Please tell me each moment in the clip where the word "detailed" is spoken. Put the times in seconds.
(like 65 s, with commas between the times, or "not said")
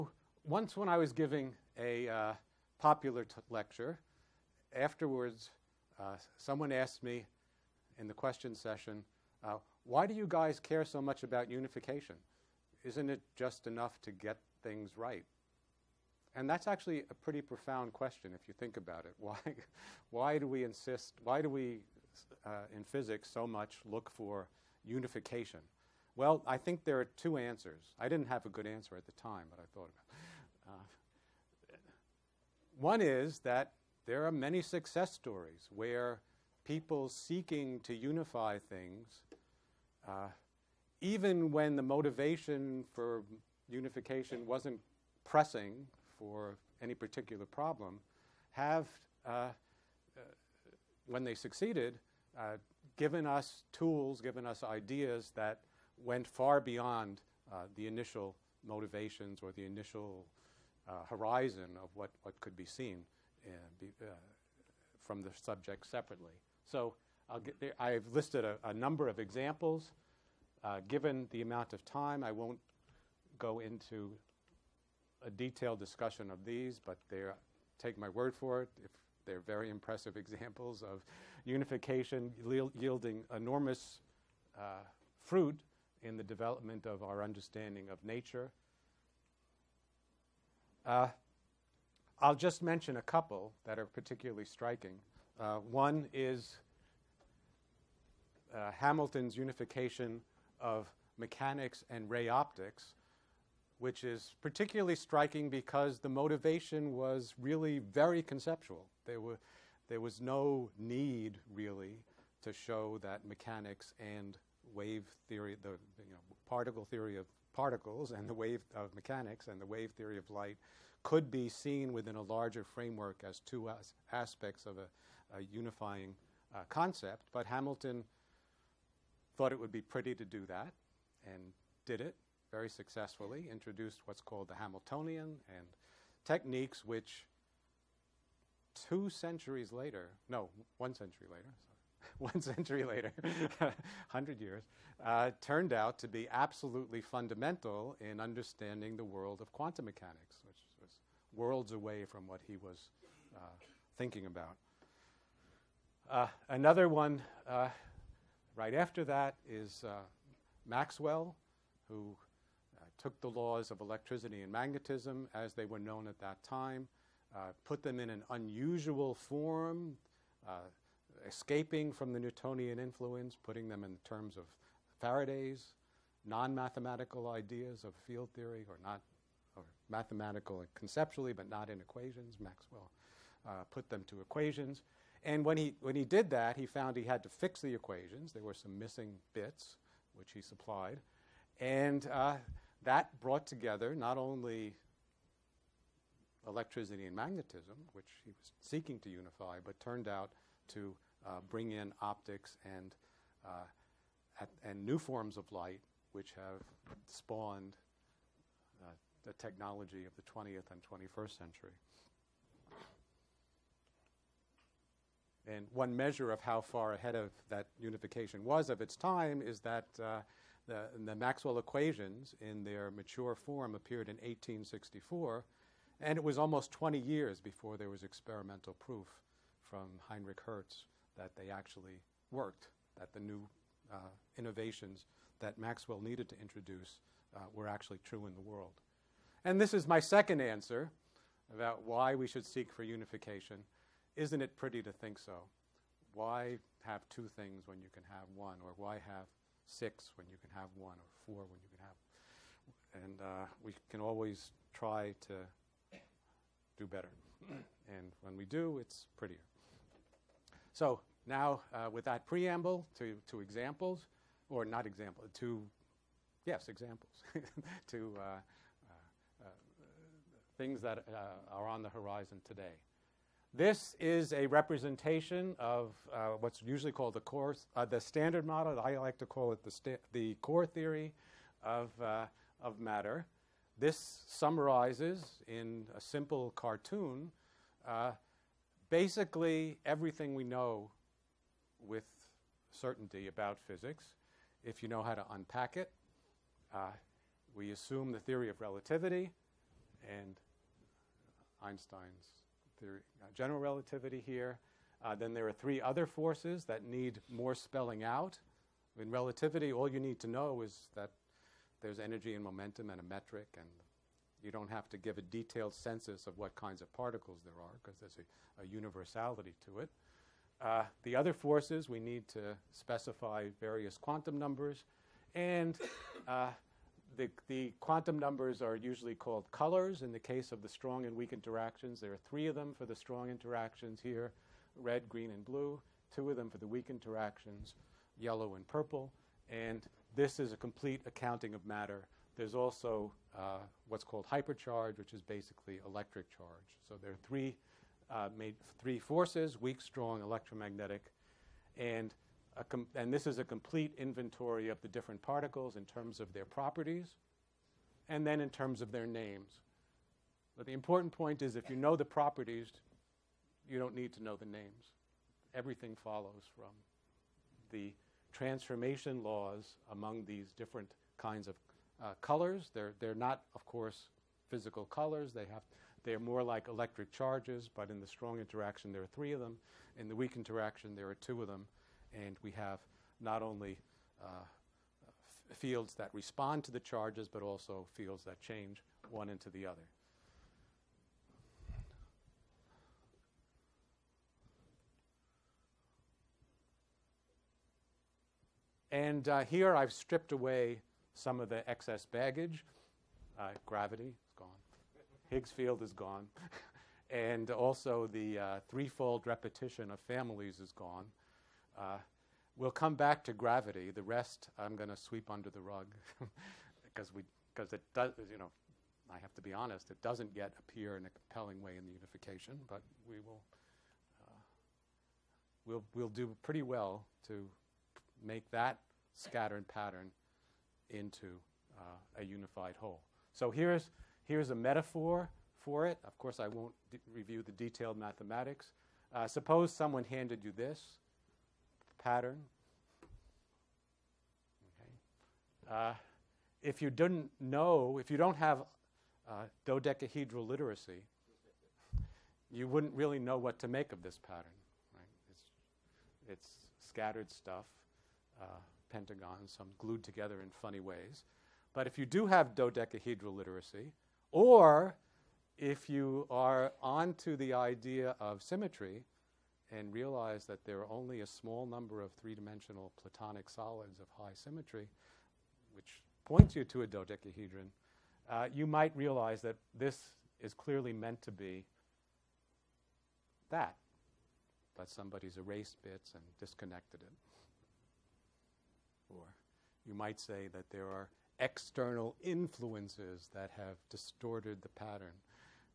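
75 s, 315 s, 437 s.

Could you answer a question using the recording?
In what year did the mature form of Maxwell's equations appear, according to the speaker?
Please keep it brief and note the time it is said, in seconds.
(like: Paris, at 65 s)
1864, at 224 s.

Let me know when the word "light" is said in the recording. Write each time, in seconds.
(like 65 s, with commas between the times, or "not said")
120 s, 205 s.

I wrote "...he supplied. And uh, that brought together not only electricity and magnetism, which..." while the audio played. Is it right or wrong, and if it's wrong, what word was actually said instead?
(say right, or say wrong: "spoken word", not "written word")
right.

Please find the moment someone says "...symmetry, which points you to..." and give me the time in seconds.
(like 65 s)
474 s.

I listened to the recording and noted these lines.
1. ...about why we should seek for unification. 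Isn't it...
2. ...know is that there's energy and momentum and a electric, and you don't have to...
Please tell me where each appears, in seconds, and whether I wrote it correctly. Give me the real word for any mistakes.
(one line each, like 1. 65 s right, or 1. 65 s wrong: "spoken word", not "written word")
1. 241 s right
2. 310 s wrong: "metric", not "electric".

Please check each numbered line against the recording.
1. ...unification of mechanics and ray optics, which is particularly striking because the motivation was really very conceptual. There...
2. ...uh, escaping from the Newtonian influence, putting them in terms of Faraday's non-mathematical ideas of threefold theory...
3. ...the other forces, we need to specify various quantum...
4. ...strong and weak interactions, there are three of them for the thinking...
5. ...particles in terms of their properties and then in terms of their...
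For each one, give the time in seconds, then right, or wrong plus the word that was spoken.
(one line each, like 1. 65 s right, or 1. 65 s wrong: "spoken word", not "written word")
1. 99 s right
2. 170 s wrong: "field", not "threefold"
3. 321 s right
4. 330 s wrong: "strong", not "thinking"
5. 355 s right.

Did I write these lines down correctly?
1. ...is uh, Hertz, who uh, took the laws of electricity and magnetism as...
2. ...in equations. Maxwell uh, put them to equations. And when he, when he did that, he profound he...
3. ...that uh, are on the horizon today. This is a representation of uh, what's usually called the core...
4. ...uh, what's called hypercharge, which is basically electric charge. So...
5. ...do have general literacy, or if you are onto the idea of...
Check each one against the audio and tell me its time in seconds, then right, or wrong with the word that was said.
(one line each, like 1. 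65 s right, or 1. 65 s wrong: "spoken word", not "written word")
1. 159 s wrong: "Maxwell", not "Hertz"
2. 181 s wrong: "found", not "profound"
3. 270 s right
4. 343 s right
5. 462 s wrong: "dodecahedral", not "general".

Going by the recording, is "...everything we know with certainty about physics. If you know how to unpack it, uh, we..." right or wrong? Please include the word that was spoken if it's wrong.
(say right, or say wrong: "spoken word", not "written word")
right.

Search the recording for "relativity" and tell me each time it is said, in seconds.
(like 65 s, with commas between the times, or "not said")
298 s, 303 s, 309 s.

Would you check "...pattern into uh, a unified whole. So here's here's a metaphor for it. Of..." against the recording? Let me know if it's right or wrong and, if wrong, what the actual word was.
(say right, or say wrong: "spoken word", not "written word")
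right.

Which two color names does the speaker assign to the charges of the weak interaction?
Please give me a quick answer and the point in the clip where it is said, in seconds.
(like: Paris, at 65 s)
yellow and purple, at 338 s.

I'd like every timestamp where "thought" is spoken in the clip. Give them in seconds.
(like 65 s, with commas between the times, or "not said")
29 s, 129 s.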